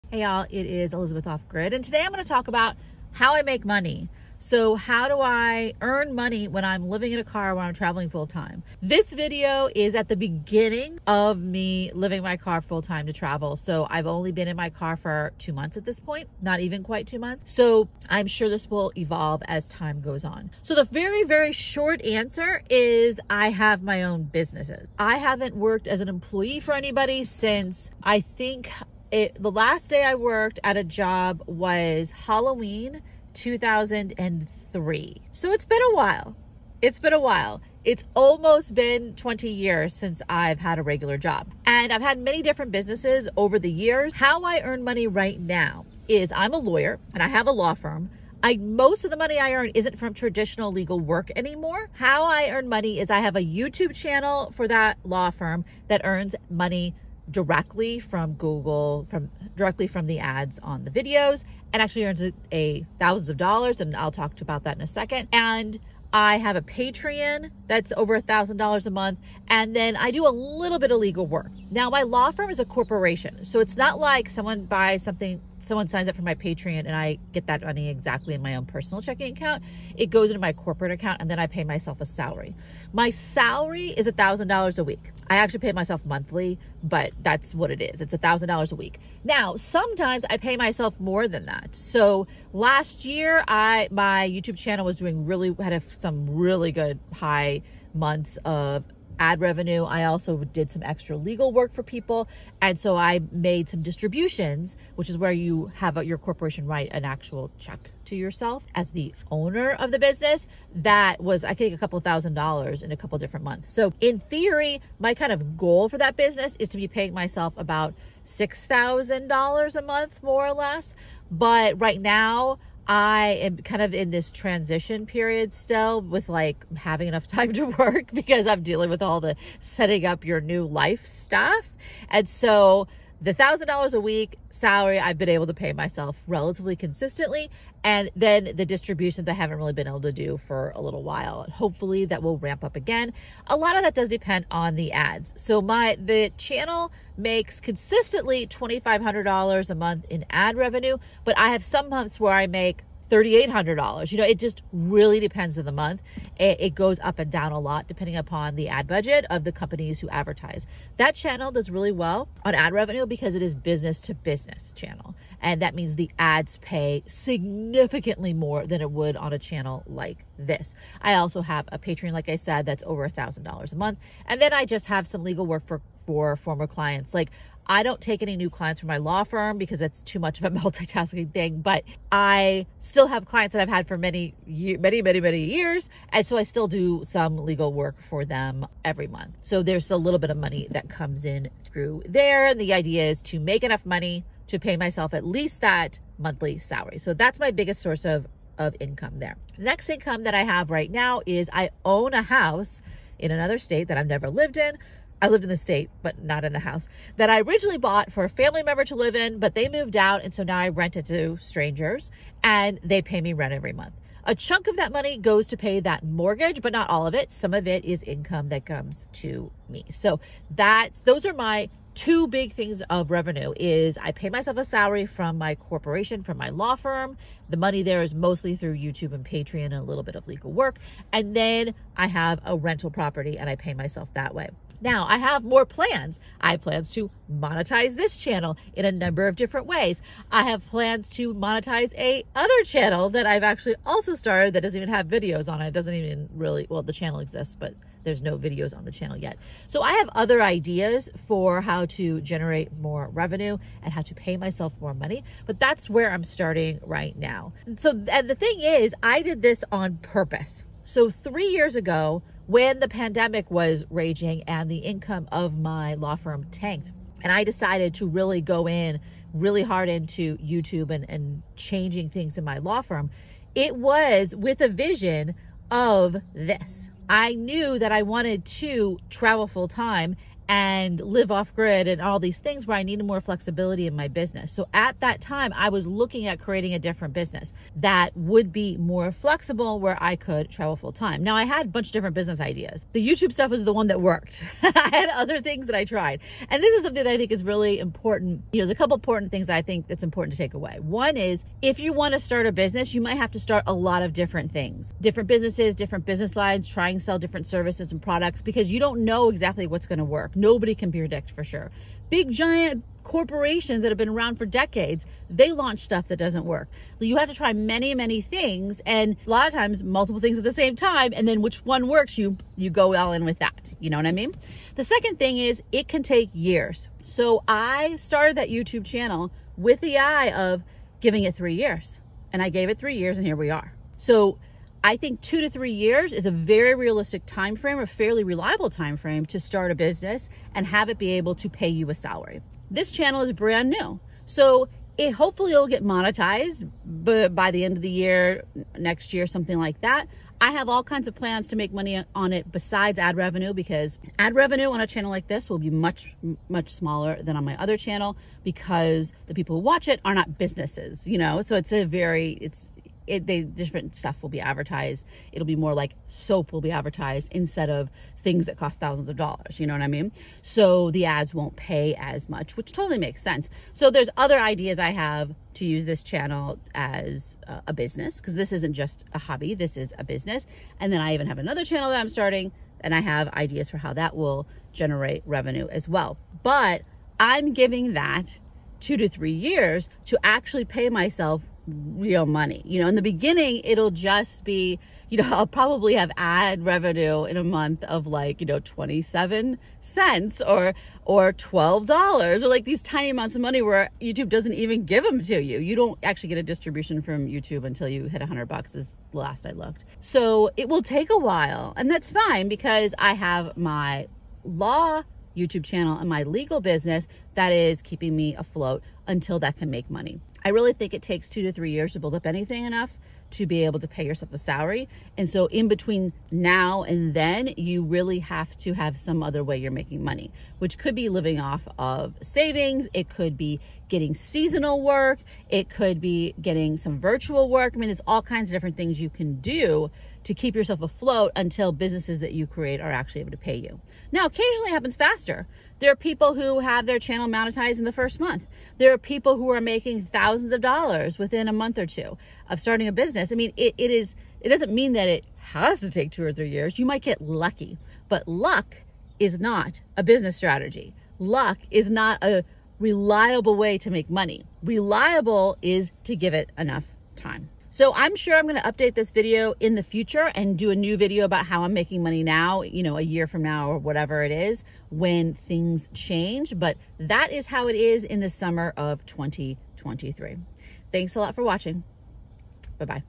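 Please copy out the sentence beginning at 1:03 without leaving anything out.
And I'll talk about that in a second.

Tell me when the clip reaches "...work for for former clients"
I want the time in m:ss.
2:55.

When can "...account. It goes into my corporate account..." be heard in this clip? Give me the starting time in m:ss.
1:19.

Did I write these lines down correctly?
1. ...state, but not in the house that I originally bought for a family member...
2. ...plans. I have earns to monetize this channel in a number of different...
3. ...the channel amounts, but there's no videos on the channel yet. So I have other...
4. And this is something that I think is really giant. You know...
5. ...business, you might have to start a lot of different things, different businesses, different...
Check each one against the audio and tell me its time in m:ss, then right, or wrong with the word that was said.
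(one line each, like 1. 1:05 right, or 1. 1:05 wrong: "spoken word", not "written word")
1. 3:25 right
2. 3:55 wrong: "plans", not "earns"
3. 4:06 wrong: "exists", not "amounts"
4. 4:56 wrong: "important", not "giant"
5. 5:02 right.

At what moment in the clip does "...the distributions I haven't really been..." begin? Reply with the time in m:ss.
2:18.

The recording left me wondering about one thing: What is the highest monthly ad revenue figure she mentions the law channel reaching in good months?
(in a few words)
$3,800.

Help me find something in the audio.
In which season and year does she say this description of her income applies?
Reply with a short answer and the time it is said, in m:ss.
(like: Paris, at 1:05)
Summer 2023, at 7:58.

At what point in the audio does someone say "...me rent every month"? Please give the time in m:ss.
3:33.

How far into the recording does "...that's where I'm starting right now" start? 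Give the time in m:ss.
4:15.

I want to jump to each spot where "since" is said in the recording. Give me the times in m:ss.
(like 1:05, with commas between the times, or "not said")
0:27, 0:39.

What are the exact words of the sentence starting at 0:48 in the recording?
I most of the money I earn isn't from traditional legal work anymore.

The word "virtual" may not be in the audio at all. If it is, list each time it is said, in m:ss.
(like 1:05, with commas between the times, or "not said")
7:16.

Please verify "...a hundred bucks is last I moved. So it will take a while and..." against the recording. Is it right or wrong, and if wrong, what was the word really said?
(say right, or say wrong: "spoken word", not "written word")
wrong: "looked", not "moved".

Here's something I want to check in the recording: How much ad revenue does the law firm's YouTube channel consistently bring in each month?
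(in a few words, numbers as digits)
$2,500.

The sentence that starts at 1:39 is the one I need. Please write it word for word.
I also did some extra legal work for people.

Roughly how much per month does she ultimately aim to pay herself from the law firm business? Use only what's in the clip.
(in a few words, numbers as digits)
$6,000.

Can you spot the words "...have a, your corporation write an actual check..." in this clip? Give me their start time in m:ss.
1:45.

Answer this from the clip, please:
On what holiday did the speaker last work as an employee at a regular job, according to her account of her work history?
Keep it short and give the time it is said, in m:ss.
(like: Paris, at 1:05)
Halloween, at 0:32.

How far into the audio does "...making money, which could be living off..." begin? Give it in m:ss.
7:09.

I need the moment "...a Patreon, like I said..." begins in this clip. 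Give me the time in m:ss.
2:51.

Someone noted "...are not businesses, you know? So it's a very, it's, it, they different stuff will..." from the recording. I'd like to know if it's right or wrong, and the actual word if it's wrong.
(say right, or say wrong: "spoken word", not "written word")
right.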